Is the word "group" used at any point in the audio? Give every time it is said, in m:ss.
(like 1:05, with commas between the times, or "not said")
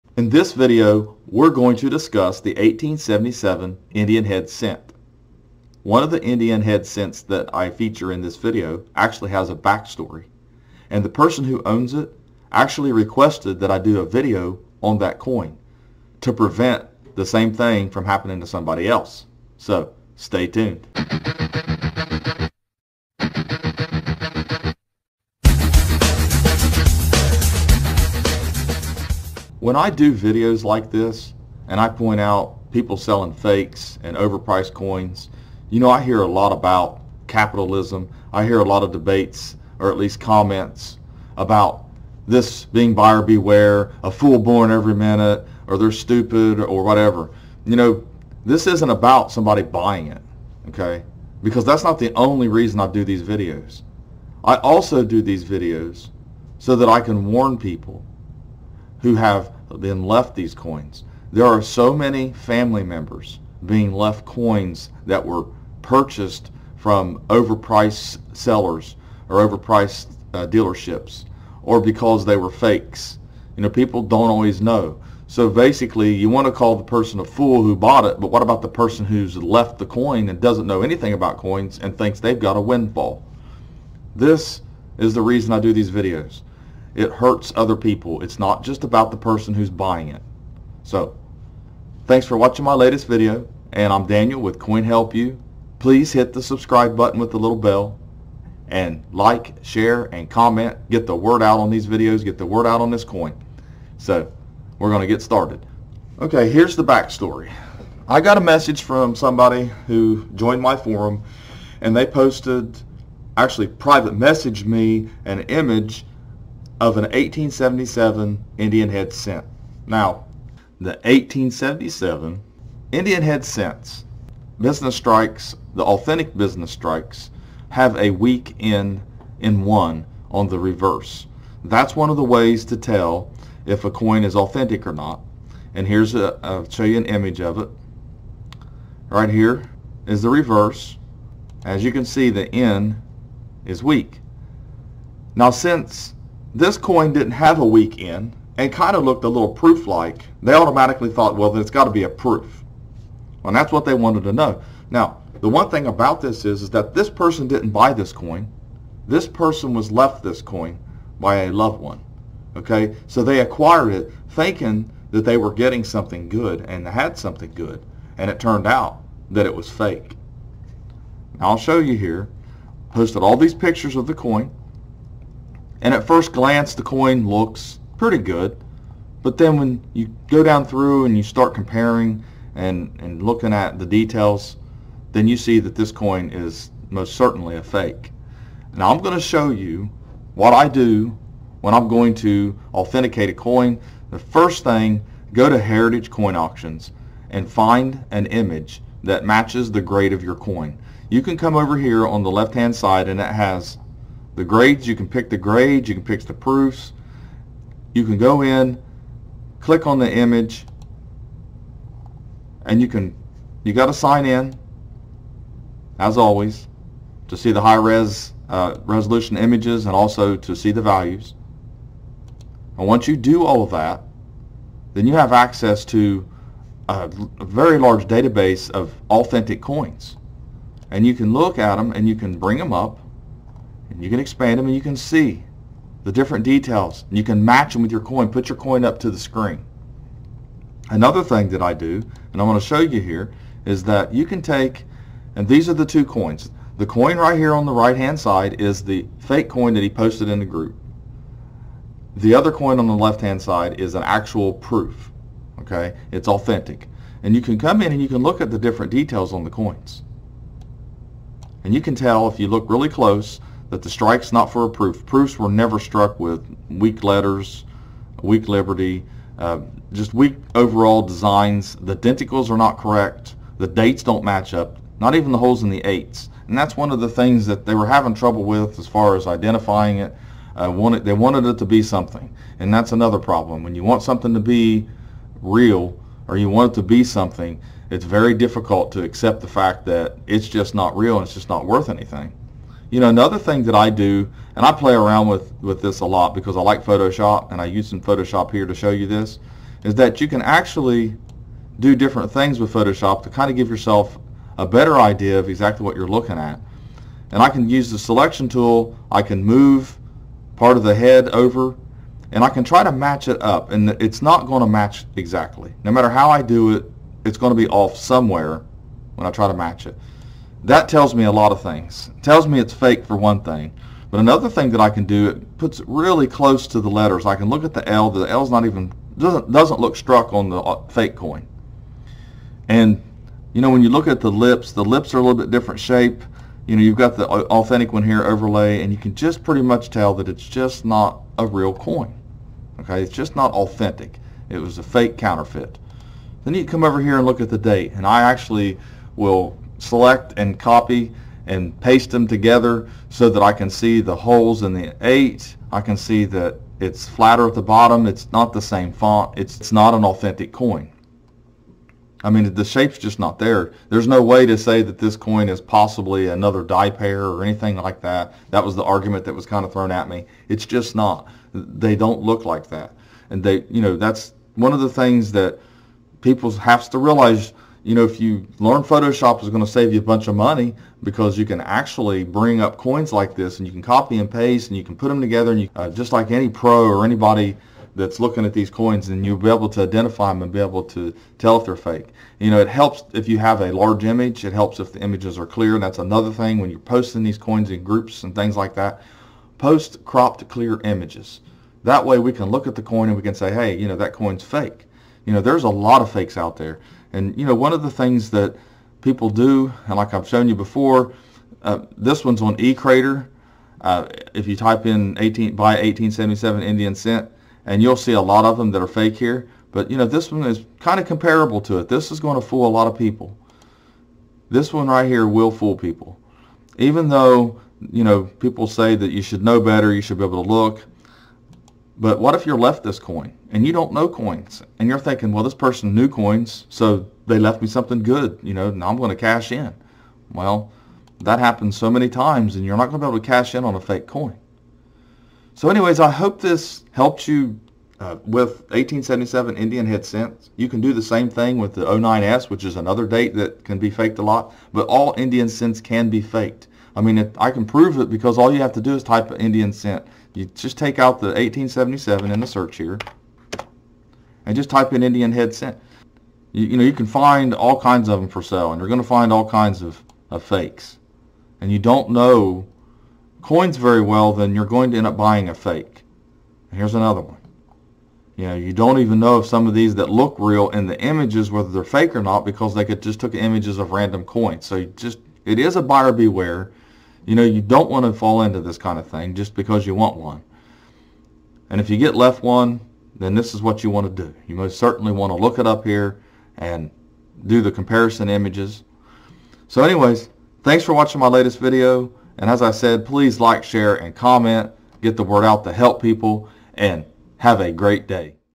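4:10, 6:37.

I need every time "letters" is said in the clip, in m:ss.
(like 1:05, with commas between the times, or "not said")
4:27, 5:26.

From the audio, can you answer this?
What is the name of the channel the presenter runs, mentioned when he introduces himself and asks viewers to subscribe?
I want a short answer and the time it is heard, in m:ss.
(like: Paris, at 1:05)
Coin Help You, at 1:34.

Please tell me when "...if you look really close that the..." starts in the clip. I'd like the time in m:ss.
4:22.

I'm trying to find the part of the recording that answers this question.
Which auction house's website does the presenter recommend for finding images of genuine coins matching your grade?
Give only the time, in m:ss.
3:15.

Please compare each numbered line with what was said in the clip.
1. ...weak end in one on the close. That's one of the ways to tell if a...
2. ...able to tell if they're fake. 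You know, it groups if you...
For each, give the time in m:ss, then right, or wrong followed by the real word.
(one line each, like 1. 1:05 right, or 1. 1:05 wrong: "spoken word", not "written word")
1. 2:08 wrong: "reverse", not "close"
2. 6:30 wrong: "helps", not "groups".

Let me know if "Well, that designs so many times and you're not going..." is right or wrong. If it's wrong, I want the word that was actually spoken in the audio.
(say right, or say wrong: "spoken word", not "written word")
wrong: "happens", not "designs".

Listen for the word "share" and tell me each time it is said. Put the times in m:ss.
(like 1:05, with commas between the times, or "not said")
1:39, 8:23.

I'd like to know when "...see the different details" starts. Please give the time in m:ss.
3:54.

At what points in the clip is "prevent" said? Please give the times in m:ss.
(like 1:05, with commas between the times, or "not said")
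0:16.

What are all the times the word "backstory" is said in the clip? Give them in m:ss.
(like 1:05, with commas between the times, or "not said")
0:09, 1:46.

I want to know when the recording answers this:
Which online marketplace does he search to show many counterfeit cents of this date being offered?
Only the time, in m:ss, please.
6:52.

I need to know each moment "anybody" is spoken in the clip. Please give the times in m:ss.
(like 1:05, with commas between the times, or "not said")
6:27.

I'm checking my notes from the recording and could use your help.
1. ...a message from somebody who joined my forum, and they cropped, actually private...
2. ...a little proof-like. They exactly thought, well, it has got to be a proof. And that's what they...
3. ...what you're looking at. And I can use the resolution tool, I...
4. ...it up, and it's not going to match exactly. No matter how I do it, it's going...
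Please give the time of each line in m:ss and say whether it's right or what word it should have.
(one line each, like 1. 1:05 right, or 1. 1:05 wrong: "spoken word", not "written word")
1. 1:48 wrong: "posted", not "cropped"
2. 2:29 wrong: "automatically", not "exactly"
3. 5:05 wrong: "selection", not "resolution"
4. 5:13 right.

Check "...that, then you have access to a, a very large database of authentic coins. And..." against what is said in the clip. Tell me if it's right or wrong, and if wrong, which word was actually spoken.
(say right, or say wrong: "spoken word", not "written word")
right.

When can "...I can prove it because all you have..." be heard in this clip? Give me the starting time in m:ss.
7:37.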